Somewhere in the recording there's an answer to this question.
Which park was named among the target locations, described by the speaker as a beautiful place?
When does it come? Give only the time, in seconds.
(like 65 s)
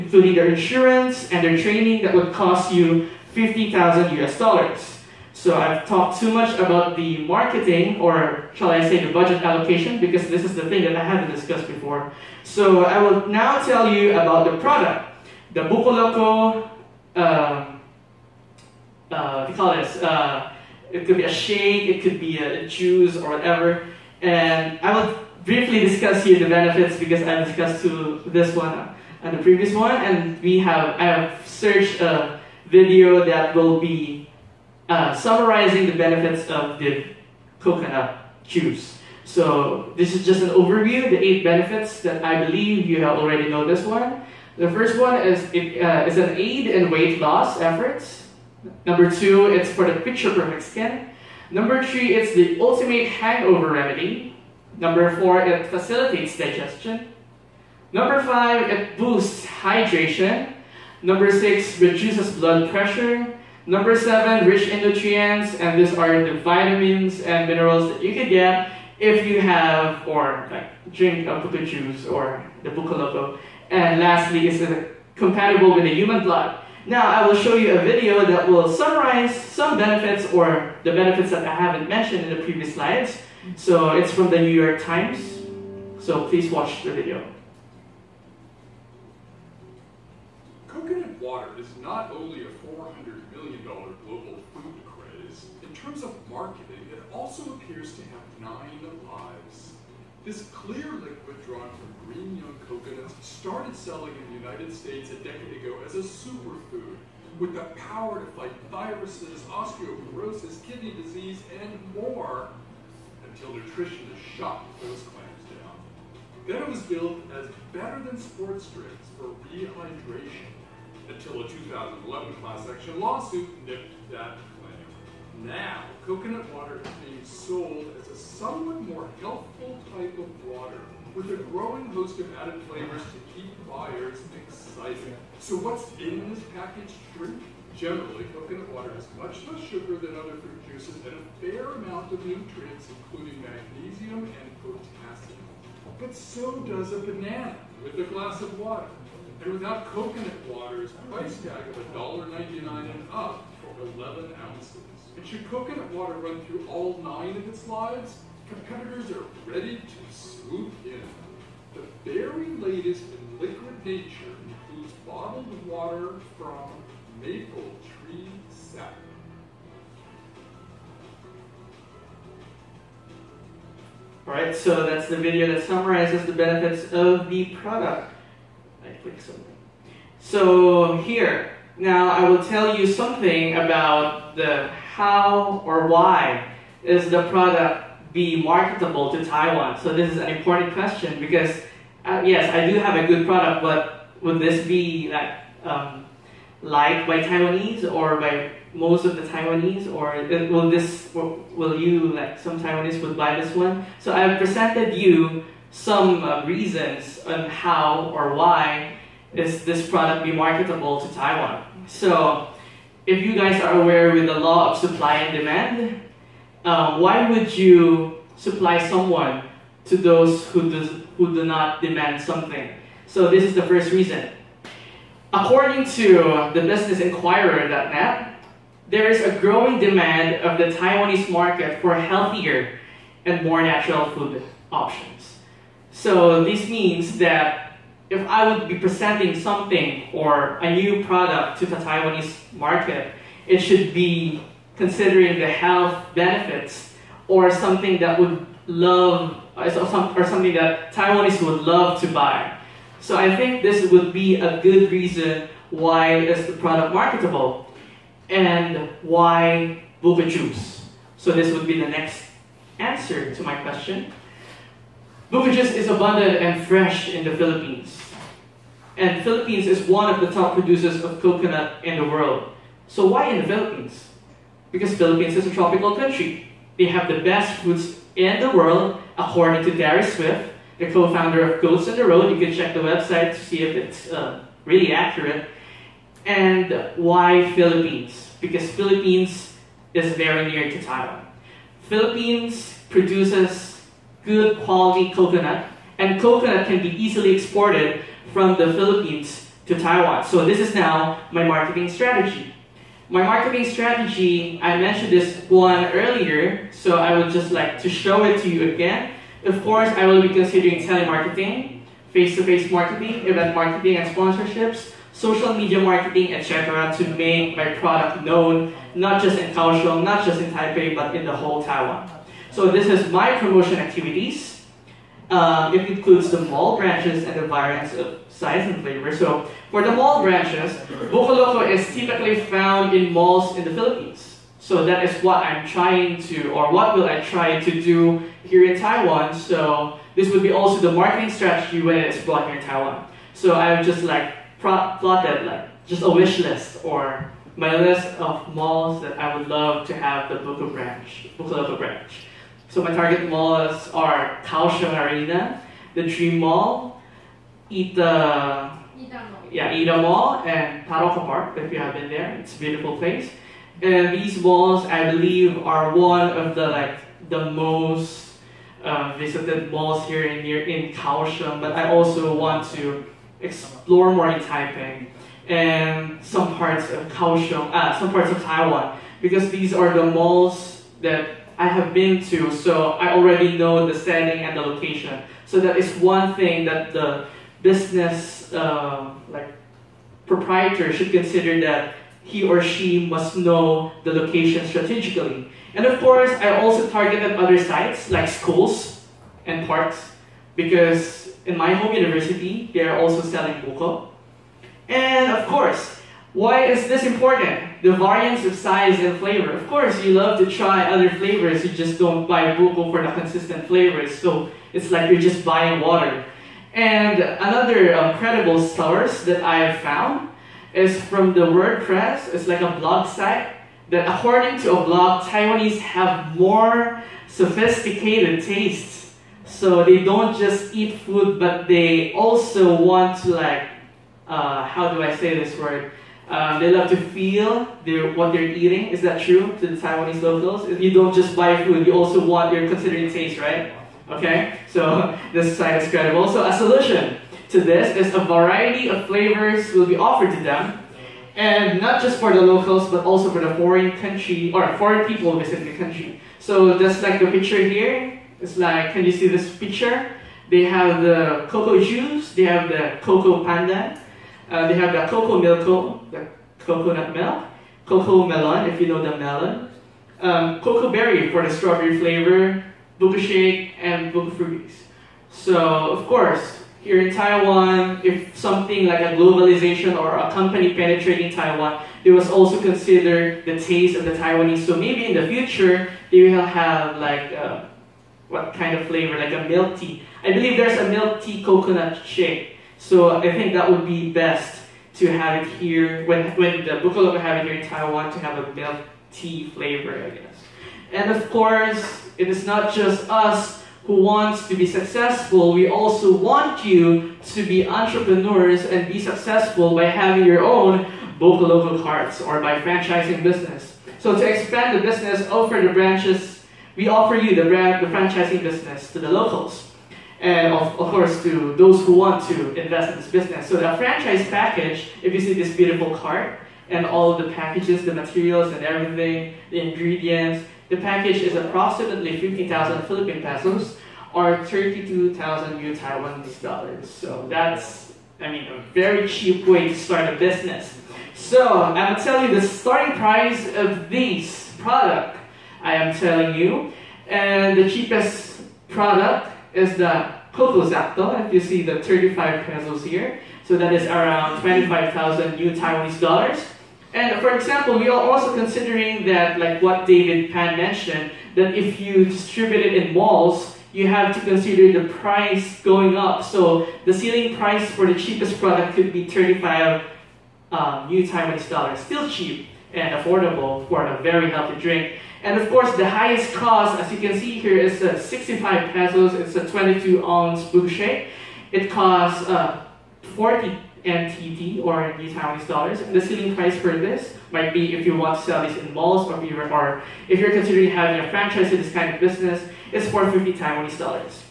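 360 s.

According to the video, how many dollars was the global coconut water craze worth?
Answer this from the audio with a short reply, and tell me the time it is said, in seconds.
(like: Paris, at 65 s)
$400 million, at 92 s.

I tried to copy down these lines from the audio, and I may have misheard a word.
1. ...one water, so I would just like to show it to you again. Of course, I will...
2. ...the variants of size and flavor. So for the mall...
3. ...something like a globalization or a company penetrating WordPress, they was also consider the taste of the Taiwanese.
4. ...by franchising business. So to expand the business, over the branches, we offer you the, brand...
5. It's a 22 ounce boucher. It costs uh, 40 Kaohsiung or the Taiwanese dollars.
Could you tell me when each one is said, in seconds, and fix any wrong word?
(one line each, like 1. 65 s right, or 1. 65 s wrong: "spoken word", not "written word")
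1. 305 s wrong: "earlier", not "water"
2. 327 s right
3. 478 s wrong: "Taiwan", not "WordPress"
4. 512 s right
5. 579 s wrong: "NTD", not "Kaohsiung".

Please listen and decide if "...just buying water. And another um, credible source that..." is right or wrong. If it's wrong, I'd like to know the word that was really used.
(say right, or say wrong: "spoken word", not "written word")
right.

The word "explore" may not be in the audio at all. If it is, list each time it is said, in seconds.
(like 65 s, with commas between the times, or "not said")
373 s.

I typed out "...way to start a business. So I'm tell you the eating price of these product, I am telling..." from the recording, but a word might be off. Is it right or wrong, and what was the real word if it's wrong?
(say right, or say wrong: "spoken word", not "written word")
wrong: "starting", not "eating".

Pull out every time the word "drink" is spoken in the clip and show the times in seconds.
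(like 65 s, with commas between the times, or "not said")
70 s, 118 s, 137 s, 574 s.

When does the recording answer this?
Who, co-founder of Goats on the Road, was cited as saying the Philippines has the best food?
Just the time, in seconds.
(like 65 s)
279 s.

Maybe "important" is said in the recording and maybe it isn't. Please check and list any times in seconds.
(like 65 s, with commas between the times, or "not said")
190 s, 407 s.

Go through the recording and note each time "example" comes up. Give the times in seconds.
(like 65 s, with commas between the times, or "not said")
557 s.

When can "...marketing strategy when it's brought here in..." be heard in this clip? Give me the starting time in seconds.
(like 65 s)
340 s.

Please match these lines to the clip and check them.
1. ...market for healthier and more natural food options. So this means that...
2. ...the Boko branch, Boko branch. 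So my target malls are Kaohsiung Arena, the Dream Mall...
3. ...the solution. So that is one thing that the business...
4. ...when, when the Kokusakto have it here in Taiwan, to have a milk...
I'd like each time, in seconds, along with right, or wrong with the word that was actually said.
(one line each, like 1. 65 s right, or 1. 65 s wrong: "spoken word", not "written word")
1. 231 s right
2. 350 s right
3. 384 s wrong: "location", not "solution"
4. 496 s wrong: "Bukalog", not "Kokusakto".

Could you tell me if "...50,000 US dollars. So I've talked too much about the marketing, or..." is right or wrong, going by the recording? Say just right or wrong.
right.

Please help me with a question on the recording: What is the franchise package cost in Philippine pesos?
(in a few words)
15,000 pesos.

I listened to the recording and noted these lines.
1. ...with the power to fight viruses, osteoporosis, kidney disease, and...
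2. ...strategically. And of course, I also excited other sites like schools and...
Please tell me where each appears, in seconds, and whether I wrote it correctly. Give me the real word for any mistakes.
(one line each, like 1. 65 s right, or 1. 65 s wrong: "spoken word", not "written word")
1. 107 s right
2. 394 s wrong: "targeted", not "excited".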